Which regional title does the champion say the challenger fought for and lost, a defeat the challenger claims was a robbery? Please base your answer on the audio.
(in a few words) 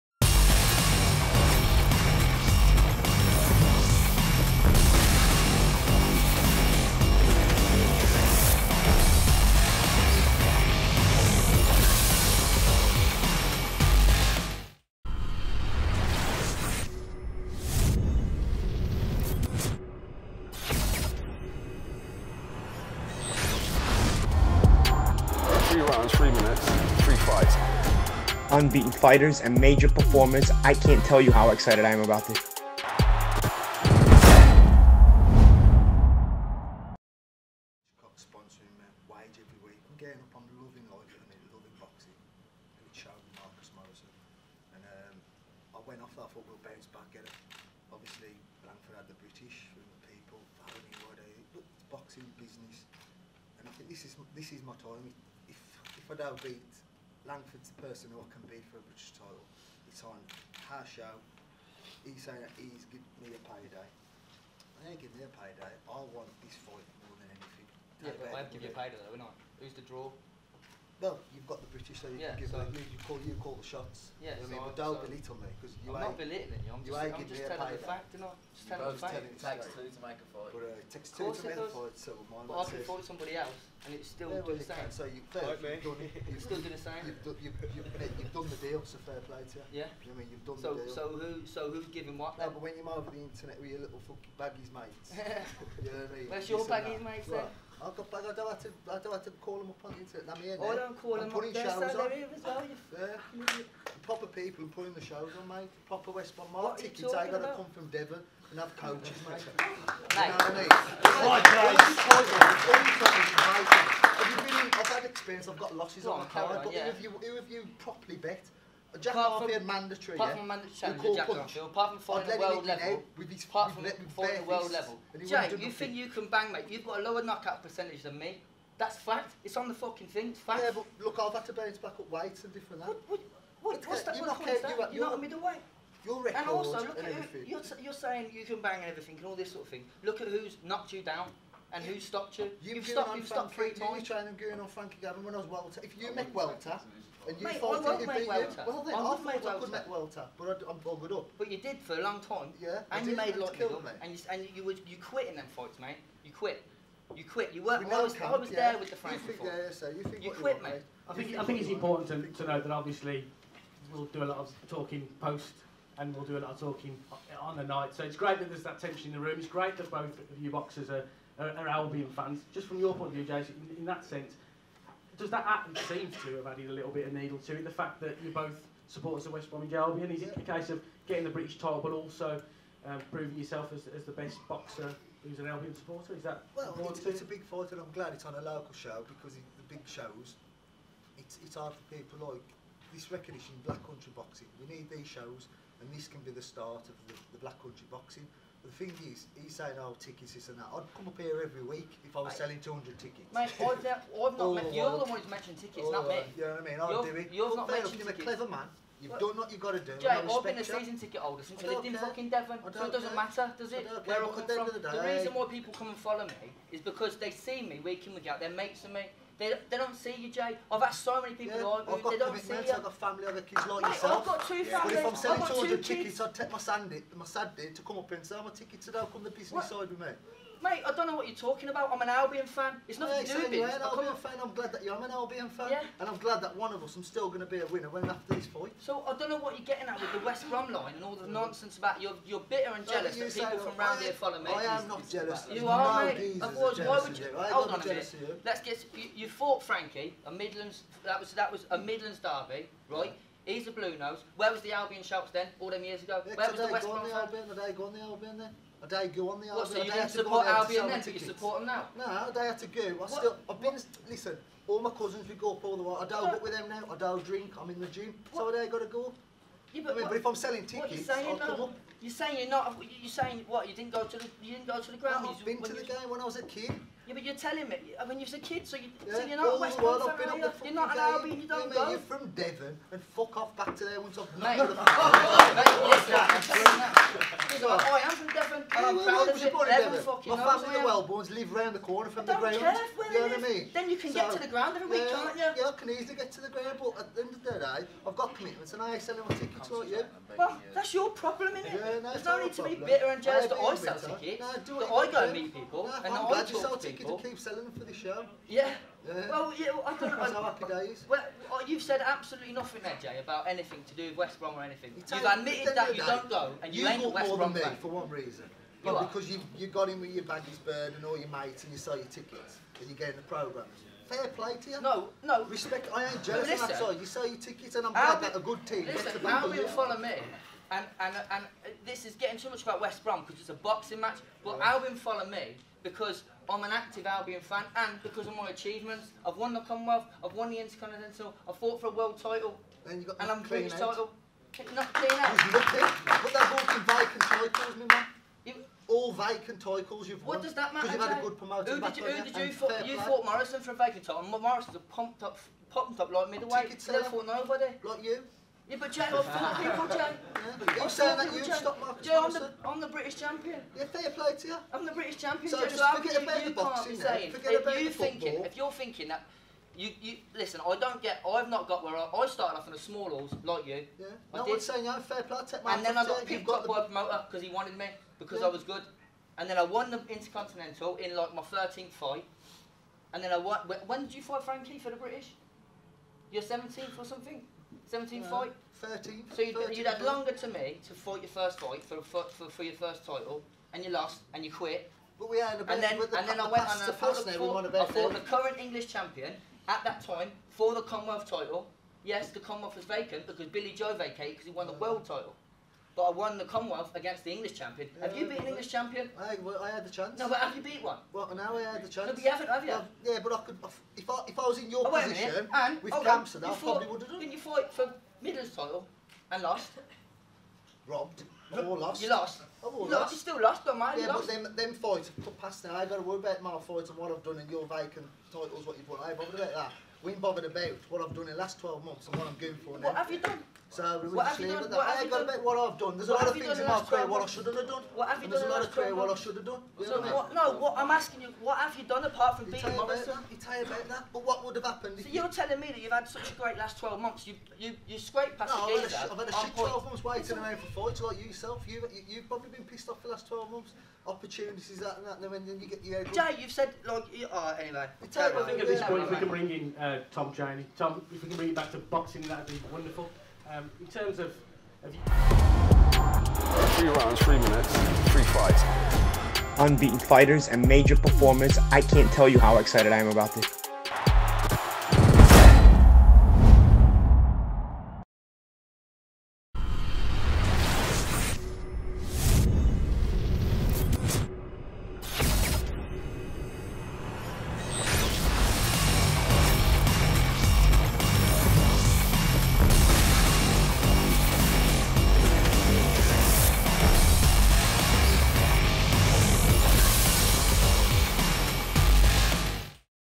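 Midlands title.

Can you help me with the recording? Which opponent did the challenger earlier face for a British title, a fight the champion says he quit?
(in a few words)
Frankie Gavin.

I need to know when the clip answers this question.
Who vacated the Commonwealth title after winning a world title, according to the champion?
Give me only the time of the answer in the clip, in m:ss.
6:43.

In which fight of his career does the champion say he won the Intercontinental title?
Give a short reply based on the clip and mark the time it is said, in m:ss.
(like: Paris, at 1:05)
13th, at 6:21.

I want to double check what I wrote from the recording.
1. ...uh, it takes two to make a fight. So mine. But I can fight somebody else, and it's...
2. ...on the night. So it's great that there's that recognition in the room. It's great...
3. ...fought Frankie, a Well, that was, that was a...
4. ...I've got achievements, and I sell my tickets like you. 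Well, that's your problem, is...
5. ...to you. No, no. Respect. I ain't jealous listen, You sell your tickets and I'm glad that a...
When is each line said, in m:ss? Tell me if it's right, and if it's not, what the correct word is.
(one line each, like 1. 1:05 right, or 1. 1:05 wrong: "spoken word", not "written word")
1. 1:20 right
2. 2:47 wrong: "tension", not "recognition"
3. 4:09 wrong: "Midlands", not "Well"
4. 4:58 wrong: "commitments", not "achievements"
5. 5:24 right.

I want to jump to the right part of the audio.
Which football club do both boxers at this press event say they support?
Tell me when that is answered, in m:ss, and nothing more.
2:59.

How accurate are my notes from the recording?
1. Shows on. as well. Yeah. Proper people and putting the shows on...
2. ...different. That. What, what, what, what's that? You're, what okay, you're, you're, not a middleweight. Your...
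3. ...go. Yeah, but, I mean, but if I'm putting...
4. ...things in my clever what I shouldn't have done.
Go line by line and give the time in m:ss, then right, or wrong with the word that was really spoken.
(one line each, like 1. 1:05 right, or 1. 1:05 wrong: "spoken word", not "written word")
1. 1:41 right
2. 2:12 right
3. 4:28 wrong: "selling", not "putting"
4. 7:16 wrong: "career", not "clever".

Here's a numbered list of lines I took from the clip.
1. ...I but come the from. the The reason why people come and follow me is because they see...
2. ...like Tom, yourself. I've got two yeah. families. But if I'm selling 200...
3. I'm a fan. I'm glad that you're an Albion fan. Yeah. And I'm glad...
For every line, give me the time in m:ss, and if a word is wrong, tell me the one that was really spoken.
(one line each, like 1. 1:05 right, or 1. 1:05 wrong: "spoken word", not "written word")
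1. 3:34 right
2. 3:43 wrong: "Mate", not "Tom"
3. 3:53 right.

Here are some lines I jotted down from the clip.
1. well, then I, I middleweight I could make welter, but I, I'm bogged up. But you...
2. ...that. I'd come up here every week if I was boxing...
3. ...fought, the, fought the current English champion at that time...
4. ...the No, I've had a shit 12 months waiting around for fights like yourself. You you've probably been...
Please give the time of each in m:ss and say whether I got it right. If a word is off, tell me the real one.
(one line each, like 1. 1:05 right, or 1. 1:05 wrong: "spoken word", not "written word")
1. 2:28 wrong: "thought", not "middleweight"
2. 3:20 wrong: "selling", not "boxing"
3. 6:36 right
4. 7:28 right.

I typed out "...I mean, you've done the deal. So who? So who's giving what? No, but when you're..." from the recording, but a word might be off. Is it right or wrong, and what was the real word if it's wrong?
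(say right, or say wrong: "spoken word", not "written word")
right.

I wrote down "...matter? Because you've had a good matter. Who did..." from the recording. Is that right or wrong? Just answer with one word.
wrong.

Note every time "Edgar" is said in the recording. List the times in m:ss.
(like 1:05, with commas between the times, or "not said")
not said.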